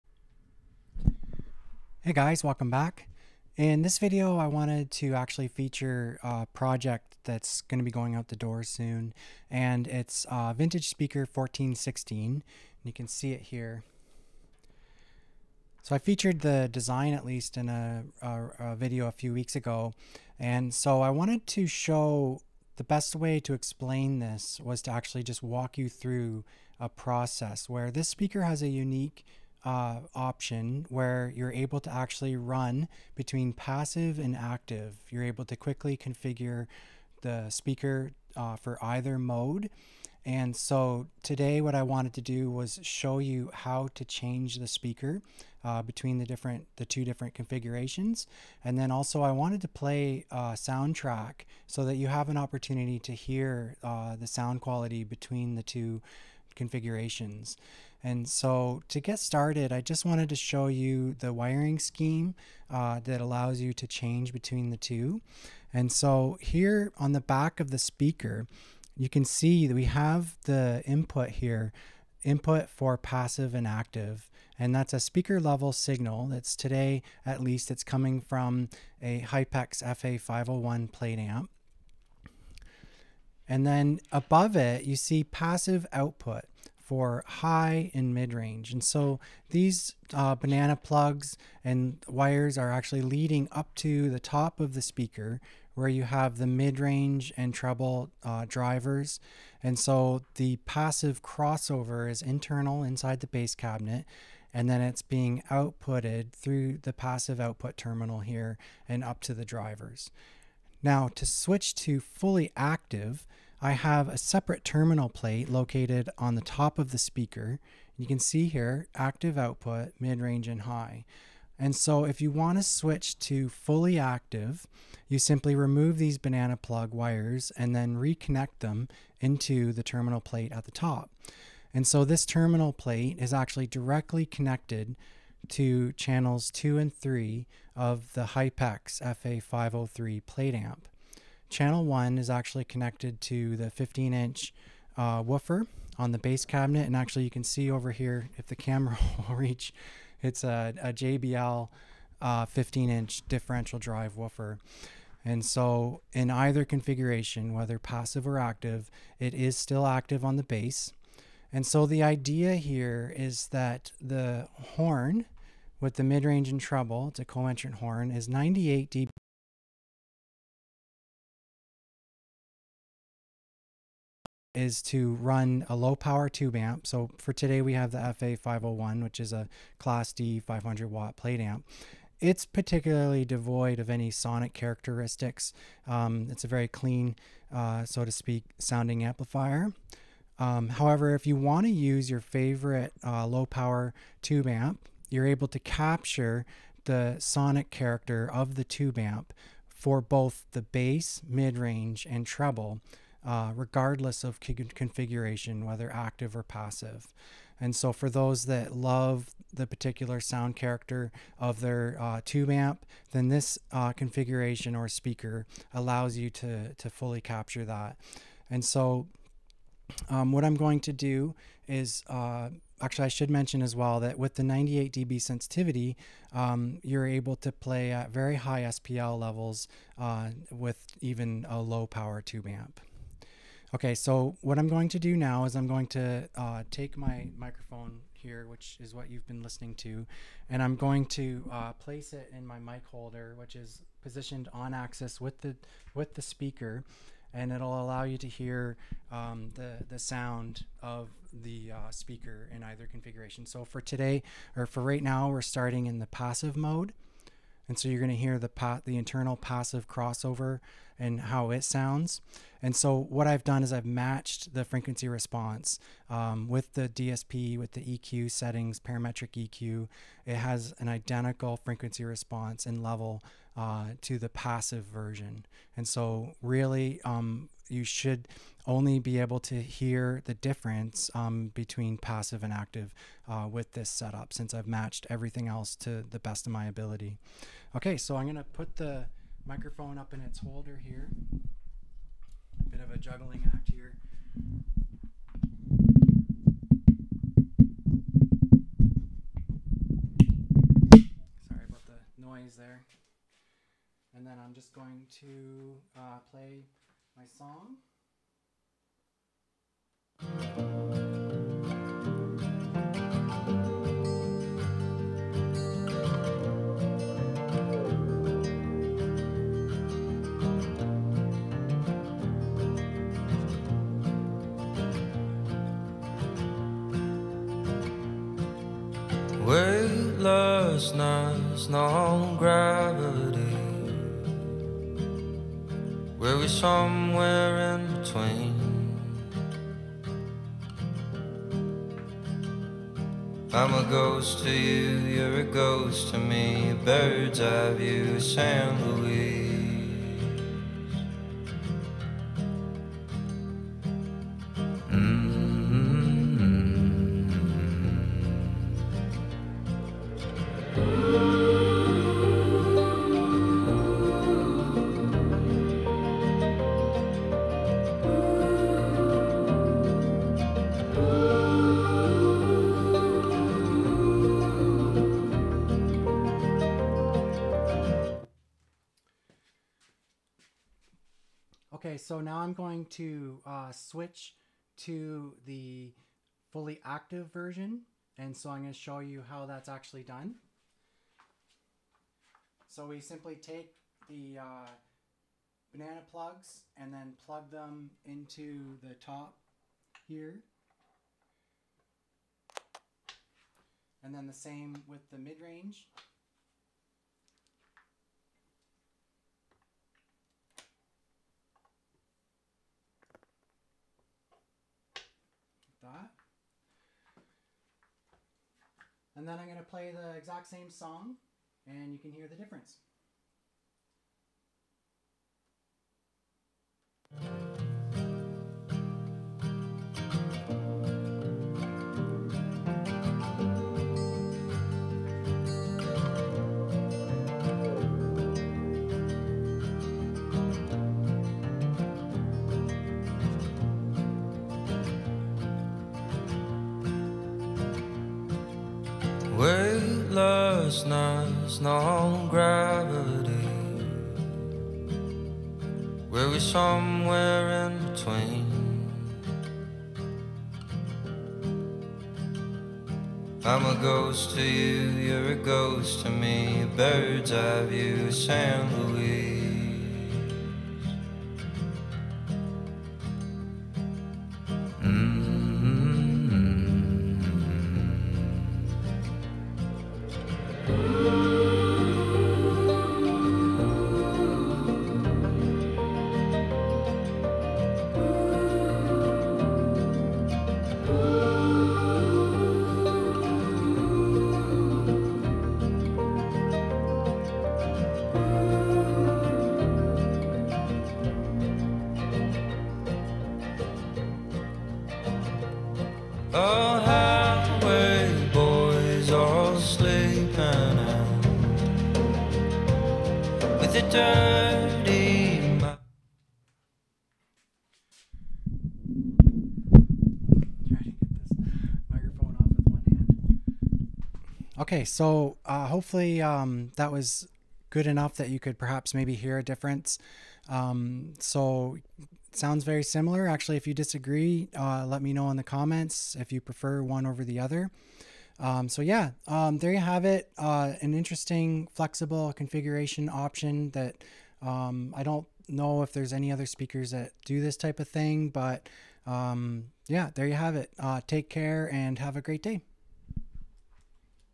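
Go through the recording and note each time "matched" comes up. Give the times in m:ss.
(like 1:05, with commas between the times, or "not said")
4:23, 4:44.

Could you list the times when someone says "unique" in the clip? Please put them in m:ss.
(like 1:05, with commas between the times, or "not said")
0:28.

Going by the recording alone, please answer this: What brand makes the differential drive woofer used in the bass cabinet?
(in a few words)
JBL.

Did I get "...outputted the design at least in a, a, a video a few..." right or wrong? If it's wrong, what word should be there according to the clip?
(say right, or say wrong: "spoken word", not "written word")
wrong: "featured", not "outputted".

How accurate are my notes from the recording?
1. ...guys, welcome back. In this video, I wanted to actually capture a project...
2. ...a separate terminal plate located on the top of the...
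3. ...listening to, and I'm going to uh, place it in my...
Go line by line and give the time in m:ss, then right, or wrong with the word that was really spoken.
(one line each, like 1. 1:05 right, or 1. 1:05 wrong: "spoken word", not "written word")
1. 0:02 wrong: "feature", not "capture"
2. 1:54 right
3. 3:59 right.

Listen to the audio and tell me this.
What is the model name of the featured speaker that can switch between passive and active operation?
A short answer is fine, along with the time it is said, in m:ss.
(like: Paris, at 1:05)
Vintage Speaker 1416, at 0:10.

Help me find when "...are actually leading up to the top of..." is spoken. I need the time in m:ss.
1:32.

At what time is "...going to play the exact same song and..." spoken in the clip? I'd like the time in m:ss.
6:59.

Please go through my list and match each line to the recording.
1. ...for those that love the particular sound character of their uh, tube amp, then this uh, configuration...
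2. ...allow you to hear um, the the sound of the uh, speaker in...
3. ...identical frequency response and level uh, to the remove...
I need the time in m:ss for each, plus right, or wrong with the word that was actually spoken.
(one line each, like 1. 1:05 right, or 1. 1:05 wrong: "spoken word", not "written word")
1. 3:27 right
2. 4:07 right
3. 4:30 wrong: "passive", not "remove".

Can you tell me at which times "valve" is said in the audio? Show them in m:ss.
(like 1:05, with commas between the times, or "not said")
not said.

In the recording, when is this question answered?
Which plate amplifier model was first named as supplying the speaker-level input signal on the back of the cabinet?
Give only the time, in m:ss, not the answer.
1:19.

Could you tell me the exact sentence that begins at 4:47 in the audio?
Okay, so I'm gonna put the microphone up in its holder here.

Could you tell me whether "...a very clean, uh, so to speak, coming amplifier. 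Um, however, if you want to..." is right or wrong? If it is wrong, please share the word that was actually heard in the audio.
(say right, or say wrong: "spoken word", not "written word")
wrong: "sounding", not "coming".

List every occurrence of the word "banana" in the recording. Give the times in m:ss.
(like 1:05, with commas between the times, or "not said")
1:30, 2:06, 6:35.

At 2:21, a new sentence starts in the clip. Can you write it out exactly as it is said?
Channel 1 is actually connected to the 15 inch uh, woofer on the bass cabinet.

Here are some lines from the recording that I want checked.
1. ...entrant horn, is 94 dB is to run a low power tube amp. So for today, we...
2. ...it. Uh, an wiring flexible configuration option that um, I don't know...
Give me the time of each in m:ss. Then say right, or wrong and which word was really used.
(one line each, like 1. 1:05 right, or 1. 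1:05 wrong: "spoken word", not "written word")
1. 2:47 wrong: "98", not "94"
2. 9:00 wrong: "interesting", not "wiring".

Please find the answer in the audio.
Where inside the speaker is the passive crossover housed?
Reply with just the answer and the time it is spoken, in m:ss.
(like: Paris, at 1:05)
inside the bass cabinet, at 1:42.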